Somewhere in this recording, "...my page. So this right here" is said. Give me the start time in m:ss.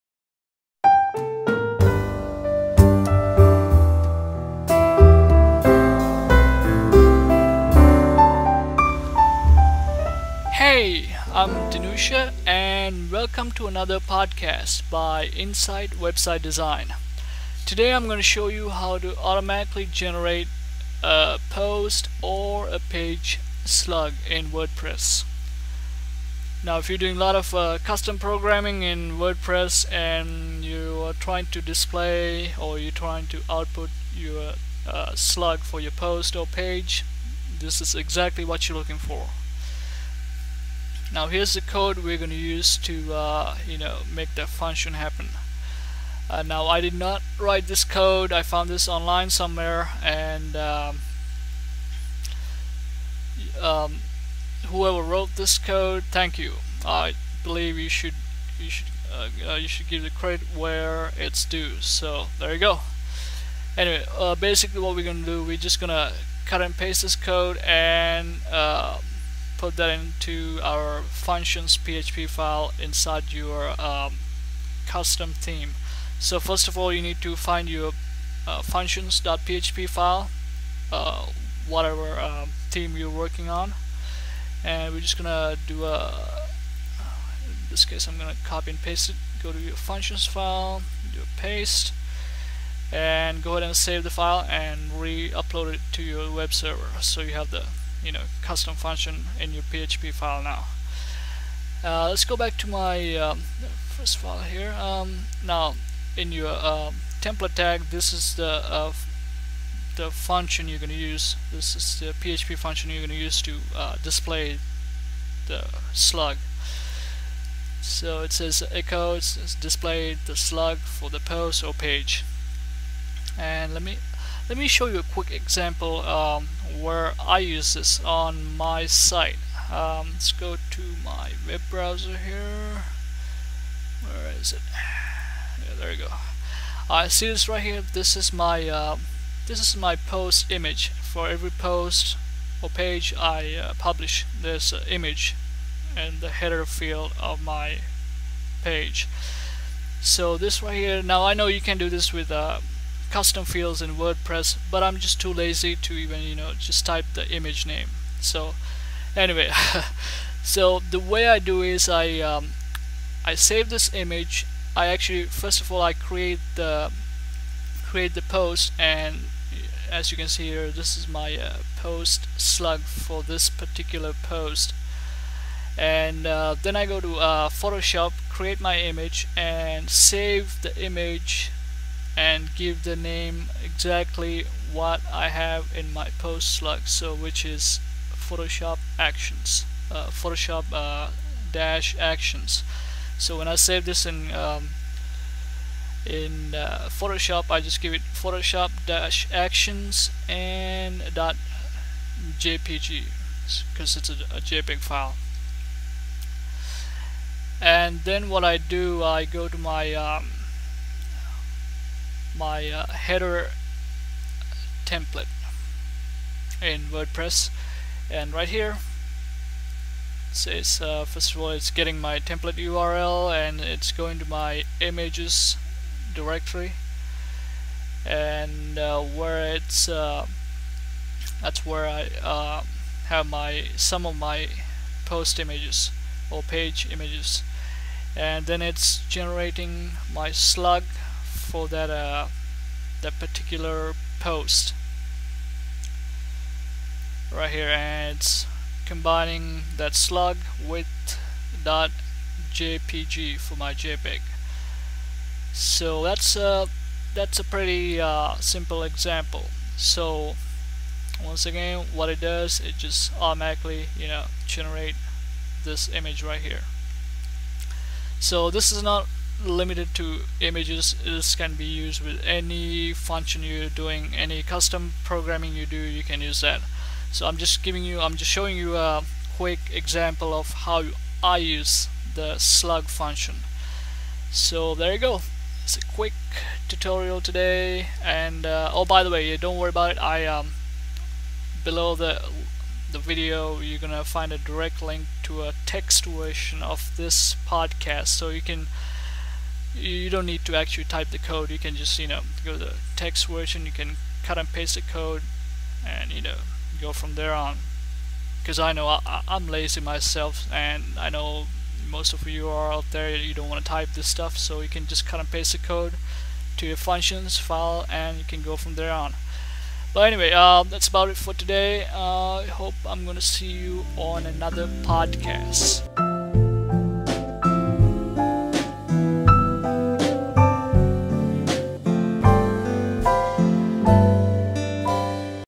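2:27.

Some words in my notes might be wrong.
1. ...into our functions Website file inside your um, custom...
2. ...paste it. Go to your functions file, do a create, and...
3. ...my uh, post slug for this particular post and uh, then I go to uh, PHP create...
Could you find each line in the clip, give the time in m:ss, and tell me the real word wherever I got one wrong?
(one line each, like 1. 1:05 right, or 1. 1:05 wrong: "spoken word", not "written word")
1. 1:09 wrong: "PHP", not "Website"
2. 1:28 wrong: "paste", not "create"
3. 2:51 wrong: "Photoshop", not "PHP".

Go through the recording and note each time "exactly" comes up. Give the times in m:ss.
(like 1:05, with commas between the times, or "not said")
0:37, 3:03.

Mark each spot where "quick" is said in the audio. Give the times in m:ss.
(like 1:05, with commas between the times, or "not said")
2:05, 4:39, 4:45.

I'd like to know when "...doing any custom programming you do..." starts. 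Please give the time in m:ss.
4:33.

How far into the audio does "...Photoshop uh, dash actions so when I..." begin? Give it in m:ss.
3:10.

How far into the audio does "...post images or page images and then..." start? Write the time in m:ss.
3:55.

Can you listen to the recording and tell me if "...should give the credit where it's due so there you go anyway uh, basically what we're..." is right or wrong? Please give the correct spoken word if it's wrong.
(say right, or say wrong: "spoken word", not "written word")
right.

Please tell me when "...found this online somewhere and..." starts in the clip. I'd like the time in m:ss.
0:48.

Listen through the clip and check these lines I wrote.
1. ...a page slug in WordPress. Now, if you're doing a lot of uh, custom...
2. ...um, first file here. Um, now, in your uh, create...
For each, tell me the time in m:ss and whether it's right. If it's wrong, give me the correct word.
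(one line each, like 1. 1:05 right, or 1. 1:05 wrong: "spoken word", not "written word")
1. 0:22 right
2. 1:43 wrong: "template", not "create".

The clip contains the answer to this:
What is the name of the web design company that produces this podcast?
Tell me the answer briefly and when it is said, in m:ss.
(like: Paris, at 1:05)
Insite Website Design, at 0:15.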